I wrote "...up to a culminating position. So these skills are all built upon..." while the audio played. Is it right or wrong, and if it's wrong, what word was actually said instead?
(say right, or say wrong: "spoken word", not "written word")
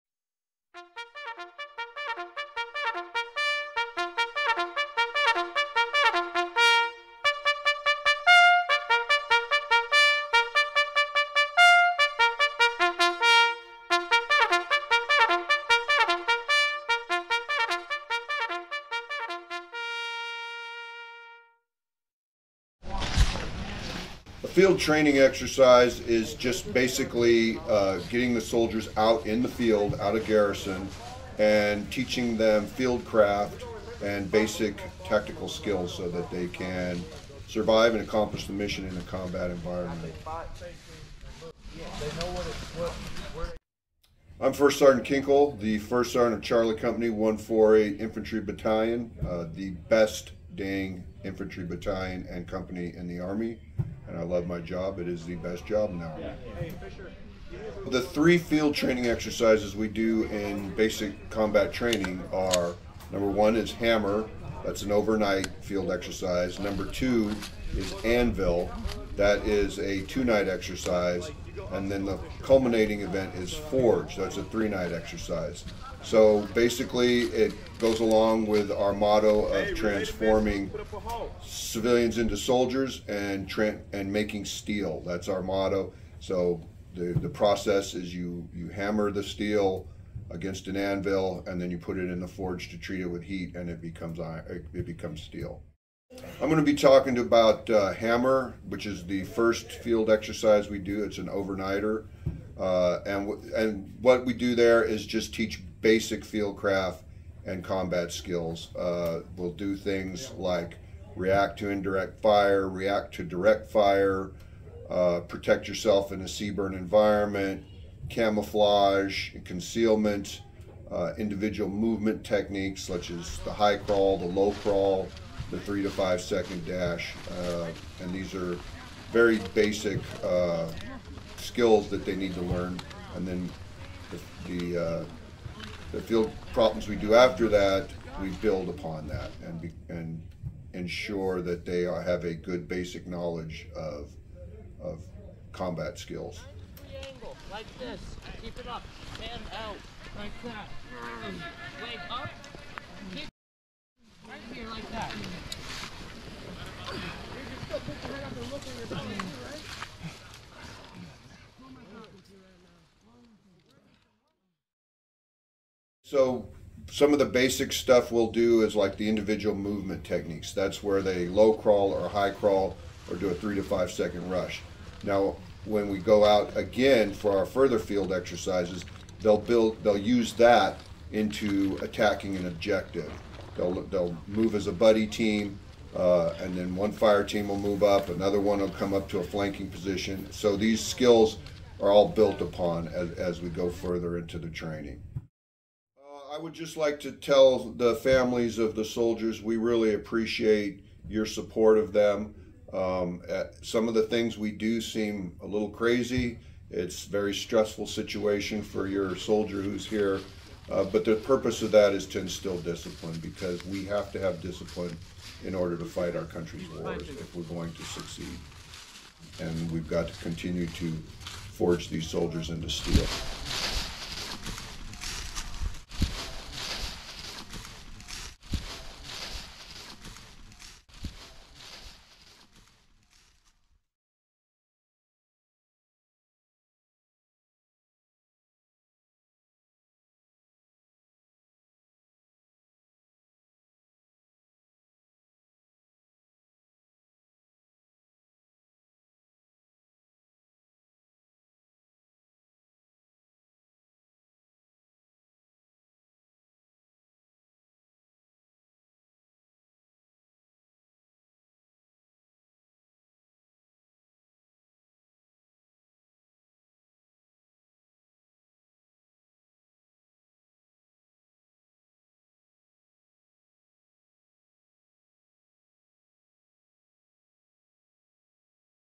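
wrong: "flanking", not "culminating".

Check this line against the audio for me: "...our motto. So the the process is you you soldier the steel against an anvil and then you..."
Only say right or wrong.
wrong.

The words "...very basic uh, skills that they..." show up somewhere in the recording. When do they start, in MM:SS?
02:09.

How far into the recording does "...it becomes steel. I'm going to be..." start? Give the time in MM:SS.
01:34.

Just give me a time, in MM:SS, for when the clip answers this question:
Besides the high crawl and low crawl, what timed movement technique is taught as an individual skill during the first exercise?
02:05.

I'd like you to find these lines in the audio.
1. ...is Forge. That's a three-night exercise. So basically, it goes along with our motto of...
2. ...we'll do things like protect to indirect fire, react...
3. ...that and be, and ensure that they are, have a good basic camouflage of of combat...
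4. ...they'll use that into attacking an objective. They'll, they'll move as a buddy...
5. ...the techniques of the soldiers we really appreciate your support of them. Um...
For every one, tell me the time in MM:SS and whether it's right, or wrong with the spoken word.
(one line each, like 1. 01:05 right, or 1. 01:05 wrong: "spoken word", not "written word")
1. 01:13 right
2. 01:49 wrong: "react", not "protect"
3. 02:19 wrong: "knowledge", not "camouflage"
4. 02:59 right
5. 03:17 wrong: "families", not "techniques".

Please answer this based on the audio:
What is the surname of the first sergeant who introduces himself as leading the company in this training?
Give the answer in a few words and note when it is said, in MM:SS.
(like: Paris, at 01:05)
Kinkle, at 00:45.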